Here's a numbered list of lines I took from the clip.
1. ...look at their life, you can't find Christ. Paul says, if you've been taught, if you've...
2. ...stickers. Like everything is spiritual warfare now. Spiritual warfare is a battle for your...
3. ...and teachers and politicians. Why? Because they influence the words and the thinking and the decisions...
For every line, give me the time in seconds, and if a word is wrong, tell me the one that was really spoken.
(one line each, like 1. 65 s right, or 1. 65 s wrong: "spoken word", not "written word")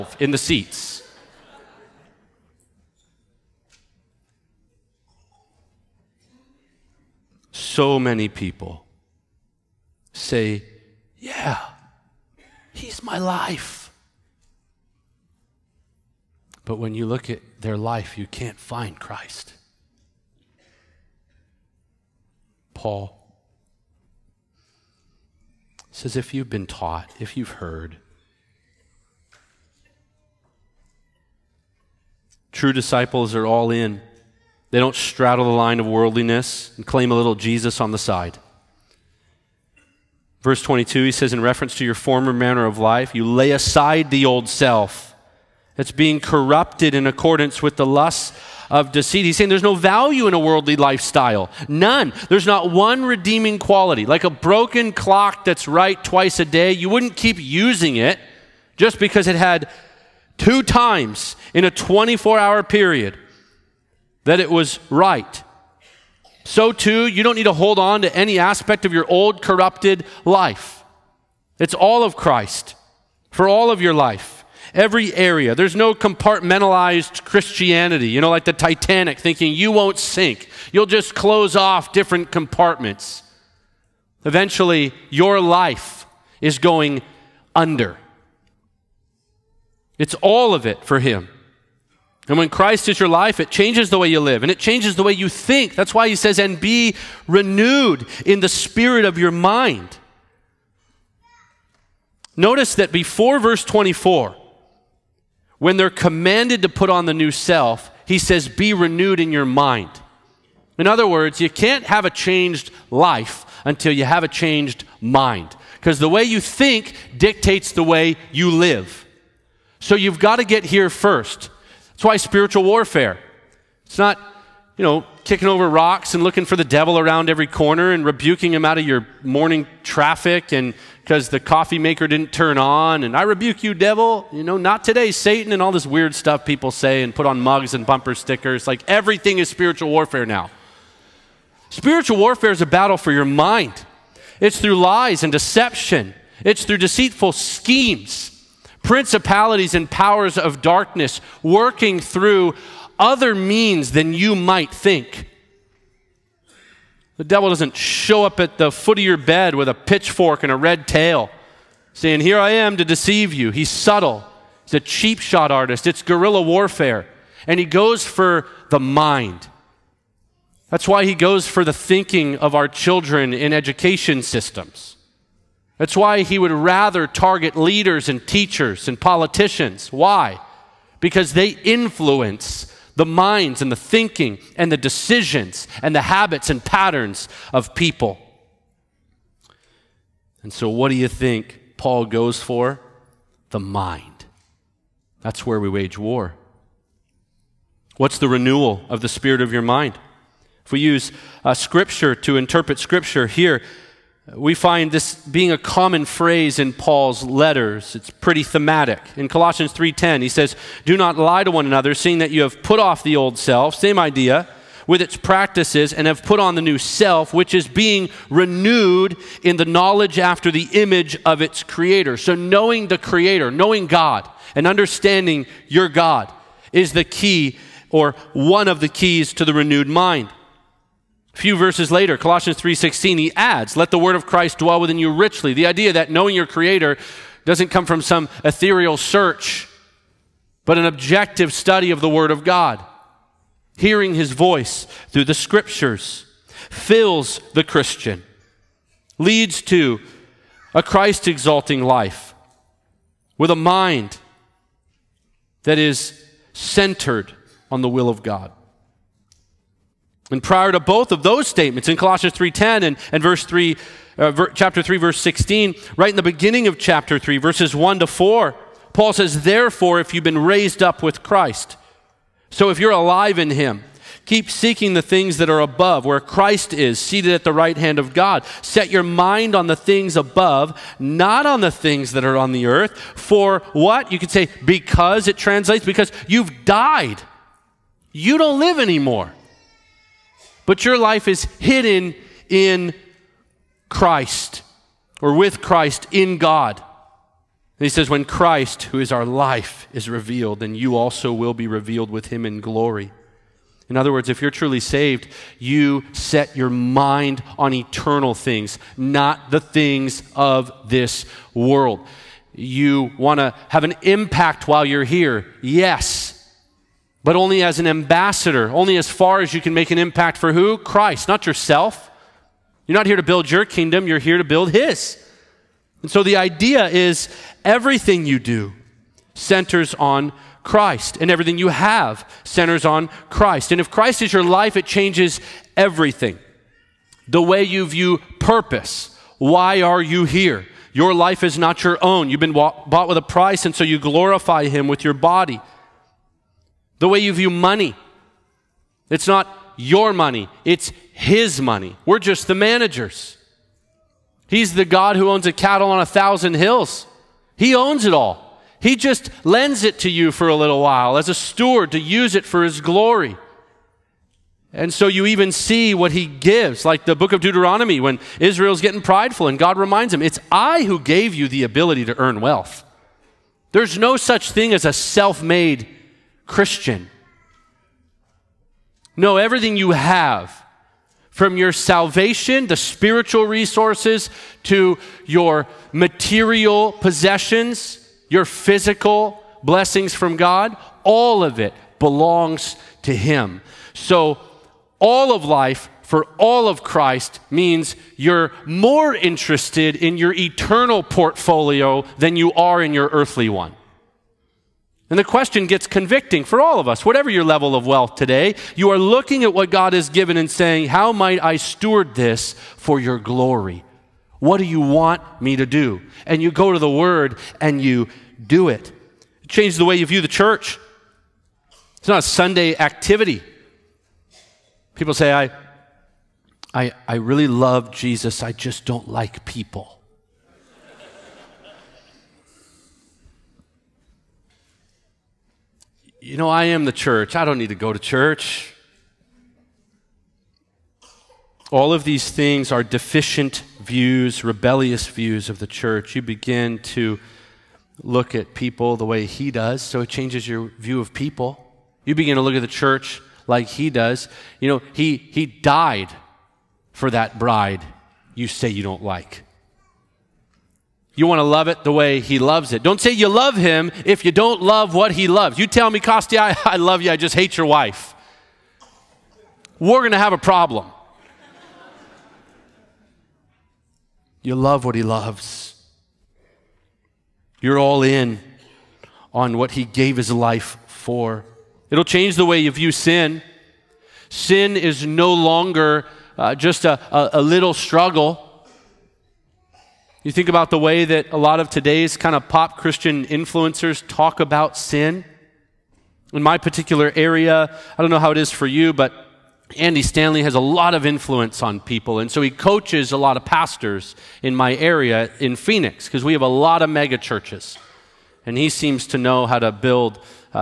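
1. 17 s right
2. 138 s right
3. 178 s wrong: "minds", not "words".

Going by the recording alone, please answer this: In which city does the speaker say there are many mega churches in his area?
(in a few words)
Phoenix.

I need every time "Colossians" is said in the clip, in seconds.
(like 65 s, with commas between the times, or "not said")
209 s, 232 s, 261 s.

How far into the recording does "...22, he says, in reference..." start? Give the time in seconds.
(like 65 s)
40 s.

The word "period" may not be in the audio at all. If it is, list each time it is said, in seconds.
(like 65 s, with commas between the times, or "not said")
62 s.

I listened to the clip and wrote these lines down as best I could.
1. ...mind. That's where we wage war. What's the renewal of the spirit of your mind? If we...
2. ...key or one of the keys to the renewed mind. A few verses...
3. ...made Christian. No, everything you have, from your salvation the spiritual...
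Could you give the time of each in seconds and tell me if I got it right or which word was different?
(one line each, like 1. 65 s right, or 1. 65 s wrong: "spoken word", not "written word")
1. 193 s right
2. 227 s right
3. 375 s right.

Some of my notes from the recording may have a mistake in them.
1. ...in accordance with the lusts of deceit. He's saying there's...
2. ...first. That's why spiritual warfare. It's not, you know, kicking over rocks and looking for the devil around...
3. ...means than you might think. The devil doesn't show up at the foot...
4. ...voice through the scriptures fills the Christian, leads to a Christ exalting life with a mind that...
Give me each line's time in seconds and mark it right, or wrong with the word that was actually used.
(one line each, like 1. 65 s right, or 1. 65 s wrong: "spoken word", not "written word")
1. 46 s right
2. 120 s right
3. 153 s right
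4. 244 s right.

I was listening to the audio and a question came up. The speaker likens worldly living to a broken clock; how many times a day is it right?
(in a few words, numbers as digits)
2.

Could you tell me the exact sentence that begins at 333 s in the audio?
And if Christ is your life, it changes everything.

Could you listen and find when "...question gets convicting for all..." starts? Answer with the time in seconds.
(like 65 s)
405 s.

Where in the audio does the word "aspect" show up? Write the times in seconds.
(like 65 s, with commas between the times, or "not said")
68 s.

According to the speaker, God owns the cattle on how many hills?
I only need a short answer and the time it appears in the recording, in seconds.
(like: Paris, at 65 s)
1000, at 355 s.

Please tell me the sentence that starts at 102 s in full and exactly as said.
Notice that before verse 24, when they're commanded to put on the new self, he says, be renewed in your mind.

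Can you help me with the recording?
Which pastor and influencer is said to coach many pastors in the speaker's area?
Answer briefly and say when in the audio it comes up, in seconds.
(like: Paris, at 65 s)
Andy Stanley, at 499 s.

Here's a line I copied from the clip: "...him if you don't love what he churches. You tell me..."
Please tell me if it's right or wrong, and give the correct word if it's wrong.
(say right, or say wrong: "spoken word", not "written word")
wrong: "loves", not "churches".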